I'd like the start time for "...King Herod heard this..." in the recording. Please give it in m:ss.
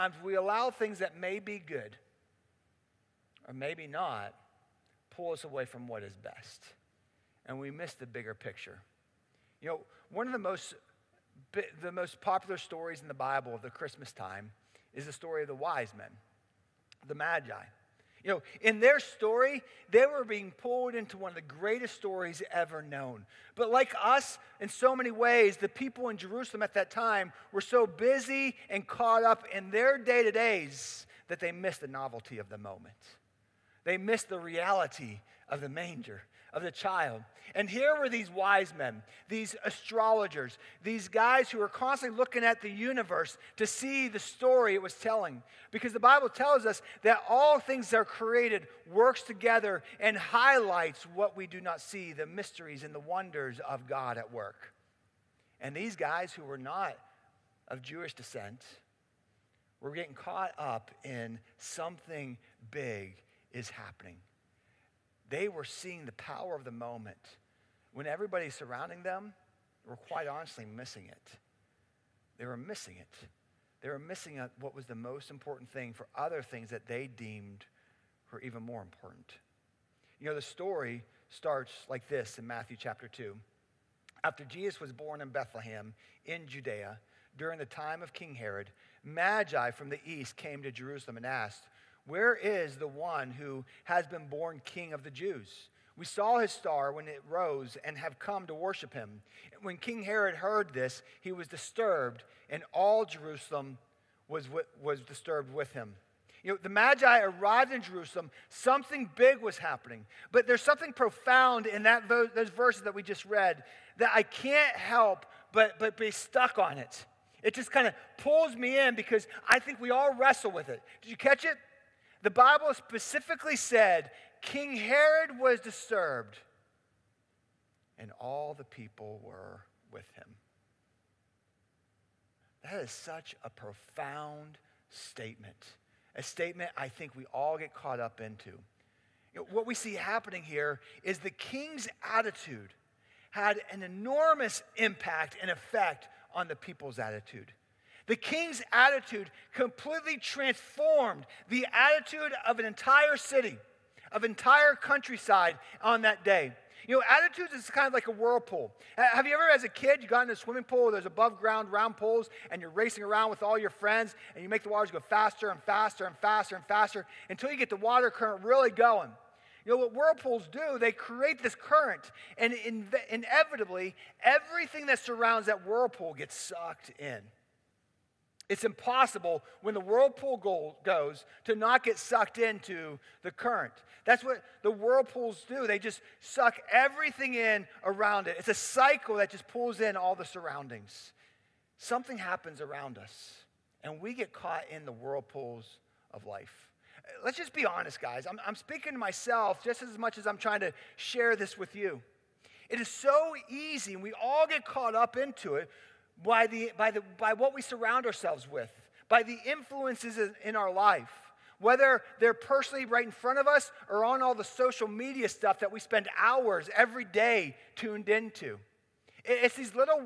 1:39.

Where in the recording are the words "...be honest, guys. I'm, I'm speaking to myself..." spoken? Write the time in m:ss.
3:17.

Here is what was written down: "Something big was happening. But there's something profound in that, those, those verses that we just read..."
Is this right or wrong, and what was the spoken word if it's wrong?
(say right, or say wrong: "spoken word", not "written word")
right.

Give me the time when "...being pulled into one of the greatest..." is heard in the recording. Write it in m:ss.
0:20.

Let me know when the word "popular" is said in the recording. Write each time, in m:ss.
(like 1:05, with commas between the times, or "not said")
0:12.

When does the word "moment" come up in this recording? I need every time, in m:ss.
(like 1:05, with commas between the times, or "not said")
0:32, 1:06.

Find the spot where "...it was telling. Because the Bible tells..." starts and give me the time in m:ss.
0:44.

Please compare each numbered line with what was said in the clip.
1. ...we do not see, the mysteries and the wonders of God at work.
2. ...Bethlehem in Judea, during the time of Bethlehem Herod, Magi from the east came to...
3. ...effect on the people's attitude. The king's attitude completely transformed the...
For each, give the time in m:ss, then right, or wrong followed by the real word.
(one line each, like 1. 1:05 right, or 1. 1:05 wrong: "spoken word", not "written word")
1. 0:51 right
2. 1:25 wrong: "King", not "Bethlehem"
3. 2:25 right.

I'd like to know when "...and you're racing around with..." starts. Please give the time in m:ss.
2:42.